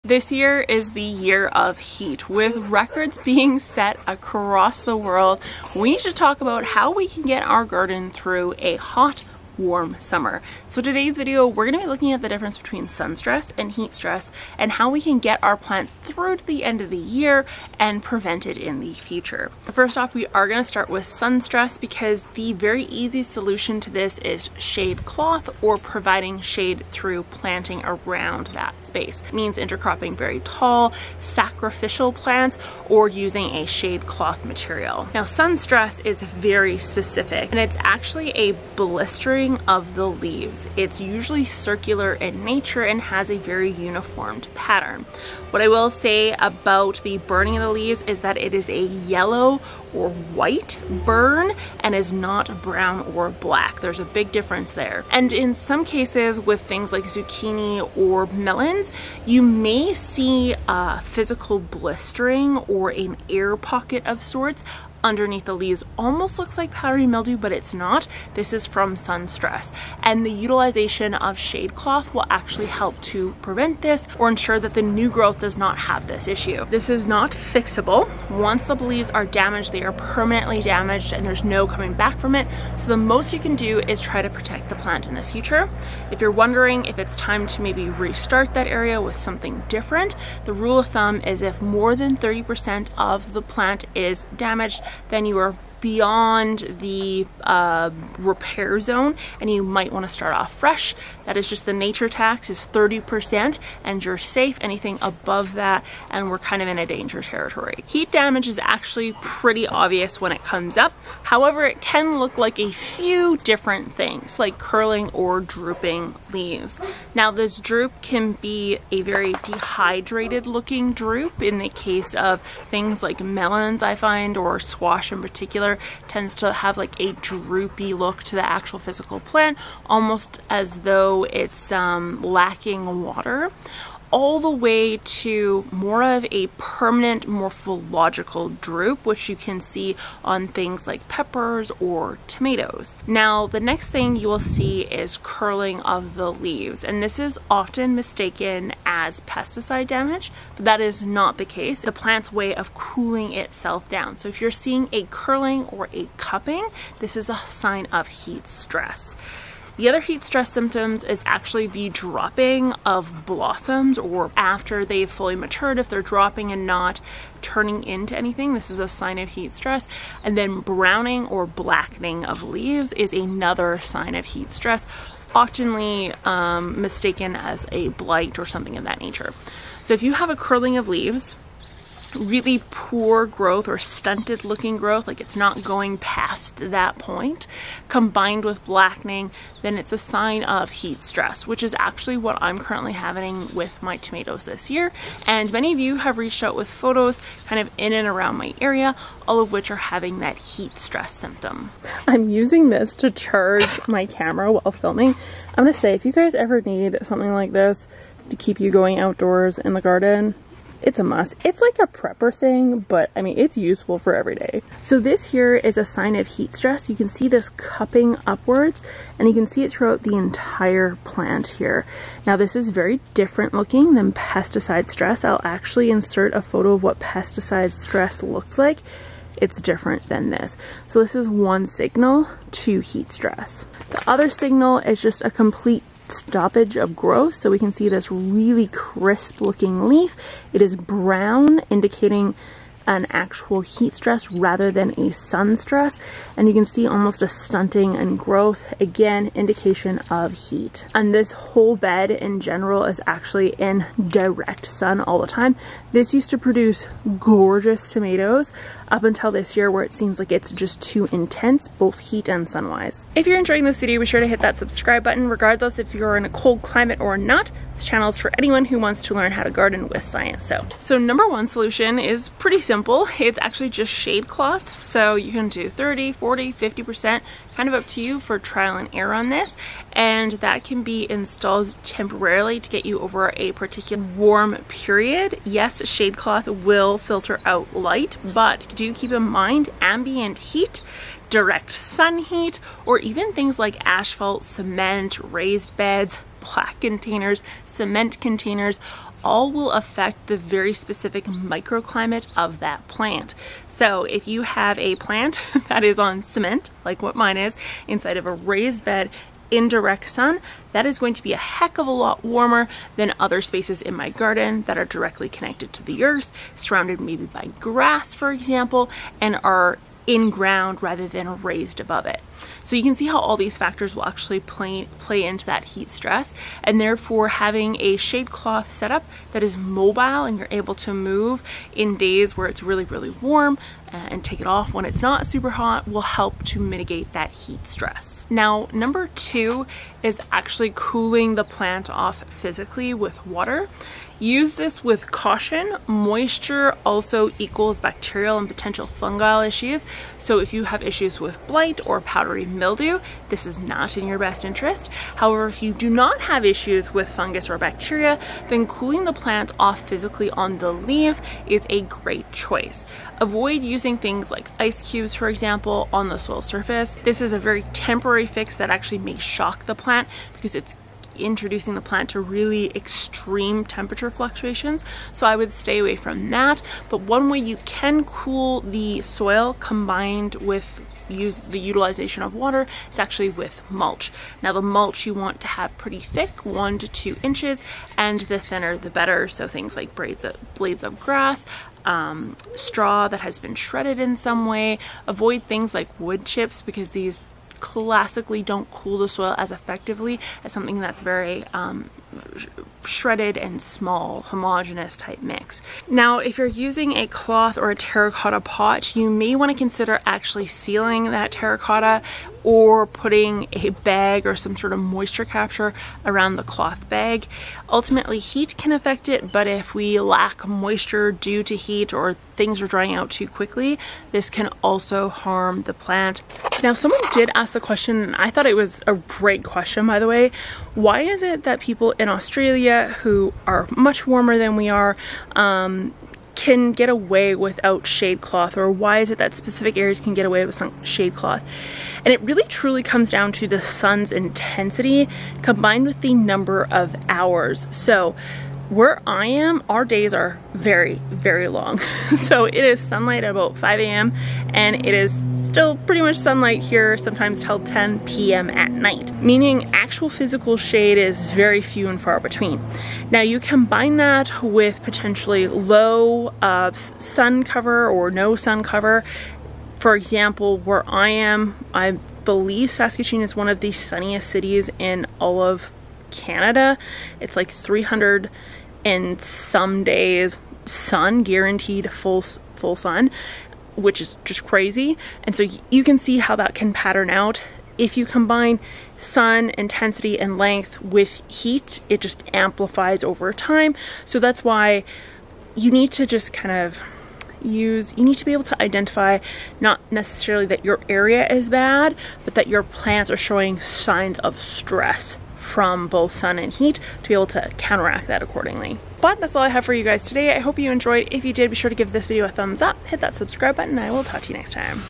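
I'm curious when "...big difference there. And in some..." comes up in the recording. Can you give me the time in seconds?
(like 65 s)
54 s.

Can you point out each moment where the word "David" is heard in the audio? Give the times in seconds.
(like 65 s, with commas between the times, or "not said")
not said.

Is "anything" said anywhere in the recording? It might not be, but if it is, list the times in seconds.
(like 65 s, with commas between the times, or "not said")
104 s, 168 s.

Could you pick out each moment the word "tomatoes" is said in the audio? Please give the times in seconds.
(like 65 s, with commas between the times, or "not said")
142 s, 193 s, 257 s.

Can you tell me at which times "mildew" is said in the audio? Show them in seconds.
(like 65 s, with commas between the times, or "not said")
67 s, 352 s.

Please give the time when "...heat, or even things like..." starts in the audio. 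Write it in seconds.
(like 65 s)
292 s.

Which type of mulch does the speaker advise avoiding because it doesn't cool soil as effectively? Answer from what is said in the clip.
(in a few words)
wood chips.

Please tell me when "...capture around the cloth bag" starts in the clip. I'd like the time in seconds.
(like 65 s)
415 s.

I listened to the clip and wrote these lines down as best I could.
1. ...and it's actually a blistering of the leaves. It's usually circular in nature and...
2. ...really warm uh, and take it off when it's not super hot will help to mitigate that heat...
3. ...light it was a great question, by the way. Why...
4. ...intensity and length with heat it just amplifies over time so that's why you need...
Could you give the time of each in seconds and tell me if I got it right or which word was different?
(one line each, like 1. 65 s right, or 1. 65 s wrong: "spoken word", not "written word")
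1. 37 s right
2. 332 s right
3. 428 s wrong: "thought", not "light"
4. 489 s right.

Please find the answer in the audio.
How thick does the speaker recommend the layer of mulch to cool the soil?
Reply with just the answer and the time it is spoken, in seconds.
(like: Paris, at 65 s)
1 to 2 inches, at 386 s.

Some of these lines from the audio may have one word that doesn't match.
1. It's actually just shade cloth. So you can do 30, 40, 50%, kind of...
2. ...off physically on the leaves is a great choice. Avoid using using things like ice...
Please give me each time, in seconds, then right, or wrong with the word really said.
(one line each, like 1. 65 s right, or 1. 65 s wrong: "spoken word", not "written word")
1. 273 s right
2. 359 s right.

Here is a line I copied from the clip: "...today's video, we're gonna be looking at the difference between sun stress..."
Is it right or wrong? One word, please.
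right.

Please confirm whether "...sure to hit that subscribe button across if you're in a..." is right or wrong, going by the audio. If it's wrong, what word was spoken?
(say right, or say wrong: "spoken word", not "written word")
wrong: "regardless", not "across".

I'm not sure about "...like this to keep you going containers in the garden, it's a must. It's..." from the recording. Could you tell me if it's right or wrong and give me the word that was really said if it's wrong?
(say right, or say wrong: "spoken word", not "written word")
wrong: "outdoors", not "containers".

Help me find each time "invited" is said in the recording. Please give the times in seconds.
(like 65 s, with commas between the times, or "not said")
not said.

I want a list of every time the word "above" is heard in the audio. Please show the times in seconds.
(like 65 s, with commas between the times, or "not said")
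105 s, 321 s.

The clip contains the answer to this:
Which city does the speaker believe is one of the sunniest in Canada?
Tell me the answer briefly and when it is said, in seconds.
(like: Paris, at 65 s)
Saskatoon, at 472 s.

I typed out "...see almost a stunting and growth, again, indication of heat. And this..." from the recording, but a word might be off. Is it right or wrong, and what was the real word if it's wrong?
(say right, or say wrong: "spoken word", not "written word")
right.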